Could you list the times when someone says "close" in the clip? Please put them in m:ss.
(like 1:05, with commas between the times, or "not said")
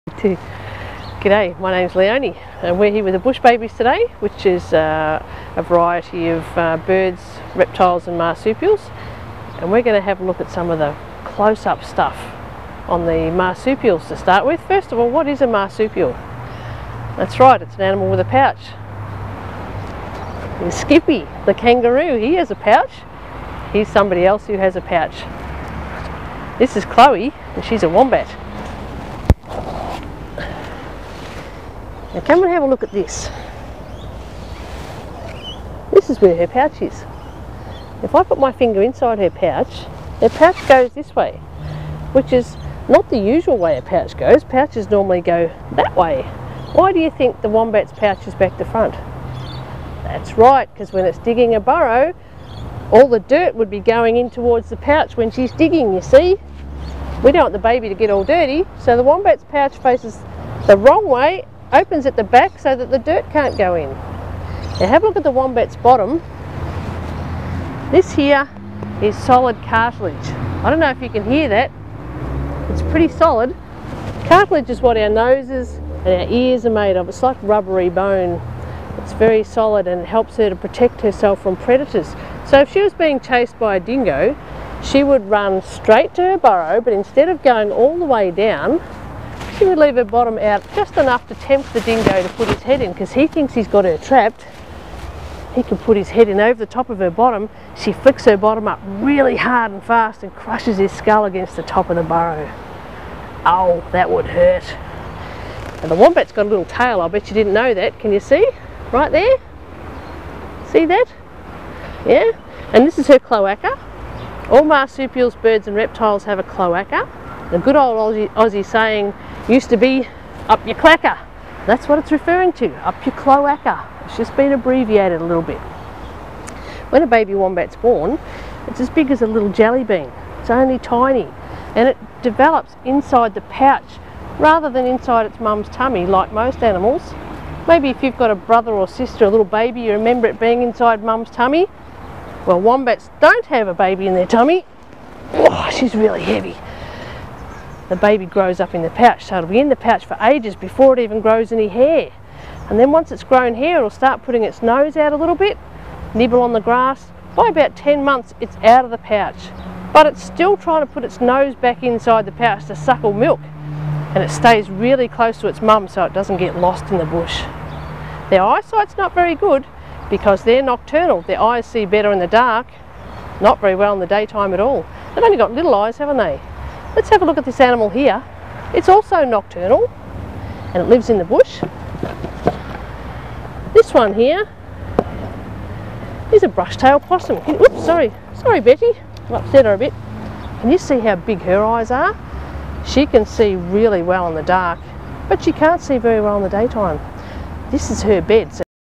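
0:11, 2:45.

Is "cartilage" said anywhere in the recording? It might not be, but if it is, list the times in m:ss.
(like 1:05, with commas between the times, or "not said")
1:09, 1:14.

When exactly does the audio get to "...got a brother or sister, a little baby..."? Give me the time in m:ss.
2:18.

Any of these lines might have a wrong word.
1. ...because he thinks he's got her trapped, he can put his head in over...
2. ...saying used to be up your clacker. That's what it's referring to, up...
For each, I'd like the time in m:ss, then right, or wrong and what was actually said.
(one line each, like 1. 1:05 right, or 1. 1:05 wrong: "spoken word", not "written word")
1. 1:32 right
2. 1:58 right.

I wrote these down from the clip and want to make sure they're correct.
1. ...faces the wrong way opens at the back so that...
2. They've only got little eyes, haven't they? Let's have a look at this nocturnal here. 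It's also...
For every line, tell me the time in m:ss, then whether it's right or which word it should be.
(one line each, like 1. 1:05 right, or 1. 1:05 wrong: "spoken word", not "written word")
1. 0:59 right
2. 2:55 wrong: "animal", not "nocturnal".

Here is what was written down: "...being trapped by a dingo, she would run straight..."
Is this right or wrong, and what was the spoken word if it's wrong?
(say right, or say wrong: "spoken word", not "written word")
wrong: "chased", not "trapped".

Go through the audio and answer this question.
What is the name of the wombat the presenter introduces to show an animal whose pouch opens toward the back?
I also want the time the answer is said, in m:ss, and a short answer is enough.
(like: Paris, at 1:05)
Chloe, at 0:26.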